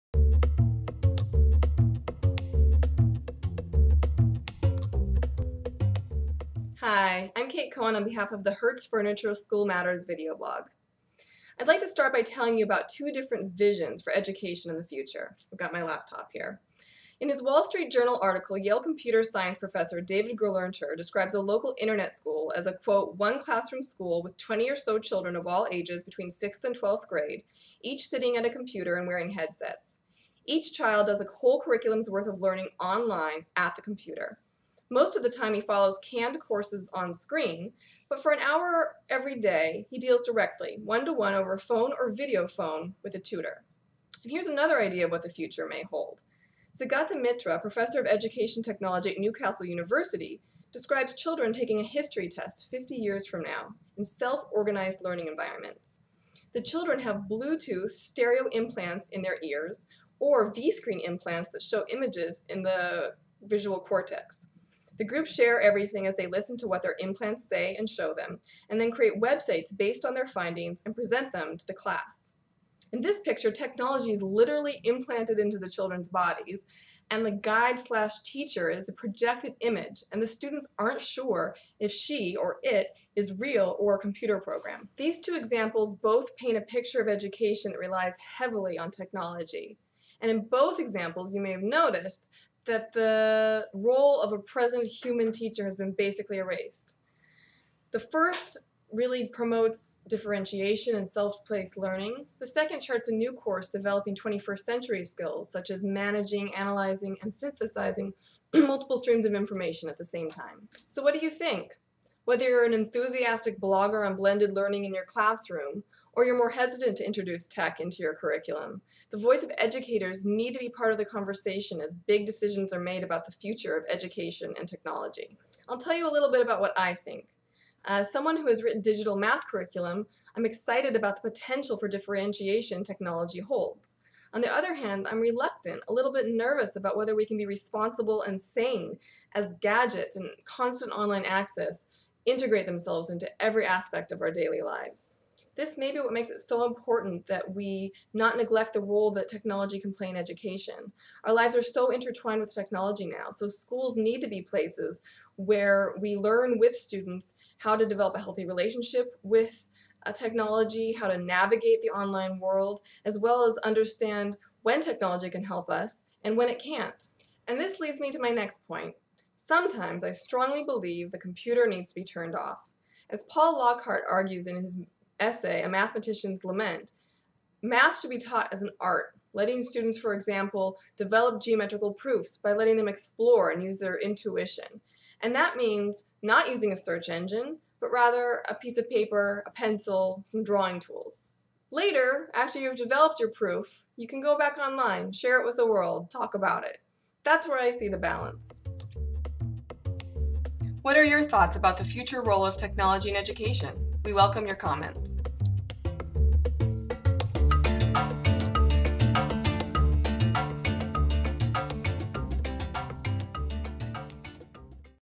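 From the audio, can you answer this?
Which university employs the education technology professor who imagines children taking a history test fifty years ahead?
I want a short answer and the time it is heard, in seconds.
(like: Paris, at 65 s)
Newcastle University, at 49 s.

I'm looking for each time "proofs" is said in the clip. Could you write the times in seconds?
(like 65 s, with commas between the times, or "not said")
181 s, 193 s.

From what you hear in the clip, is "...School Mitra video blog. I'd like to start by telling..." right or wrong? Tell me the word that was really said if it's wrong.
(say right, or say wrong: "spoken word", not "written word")
wrong: "Matters", not "Mitra".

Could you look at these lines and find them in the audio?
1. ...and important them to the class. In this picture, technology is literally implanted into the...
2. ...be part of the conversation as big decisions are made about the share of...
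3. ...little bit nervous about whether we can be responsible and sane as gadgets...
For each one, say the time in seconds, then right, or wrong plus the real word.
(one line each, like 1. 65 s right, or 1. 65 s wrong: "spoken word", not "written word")
1. 70 s wrong: "present", not "important"
2. 120 s wrong: "future", not "share"
3. 135 s right.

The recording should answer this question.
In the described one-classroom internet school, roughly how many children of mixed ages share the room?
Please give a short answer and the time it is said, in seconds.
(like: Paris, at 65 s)
20, at 24 s.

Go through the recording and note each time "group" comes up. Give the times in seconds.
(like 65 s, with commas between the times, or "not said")
65 s.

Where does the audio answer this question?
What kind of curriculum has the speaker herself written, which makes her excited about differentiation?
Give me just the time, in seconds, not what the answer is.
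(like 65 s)
128 s.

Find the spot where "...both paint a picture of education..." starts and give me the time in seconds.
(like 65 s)
85 s.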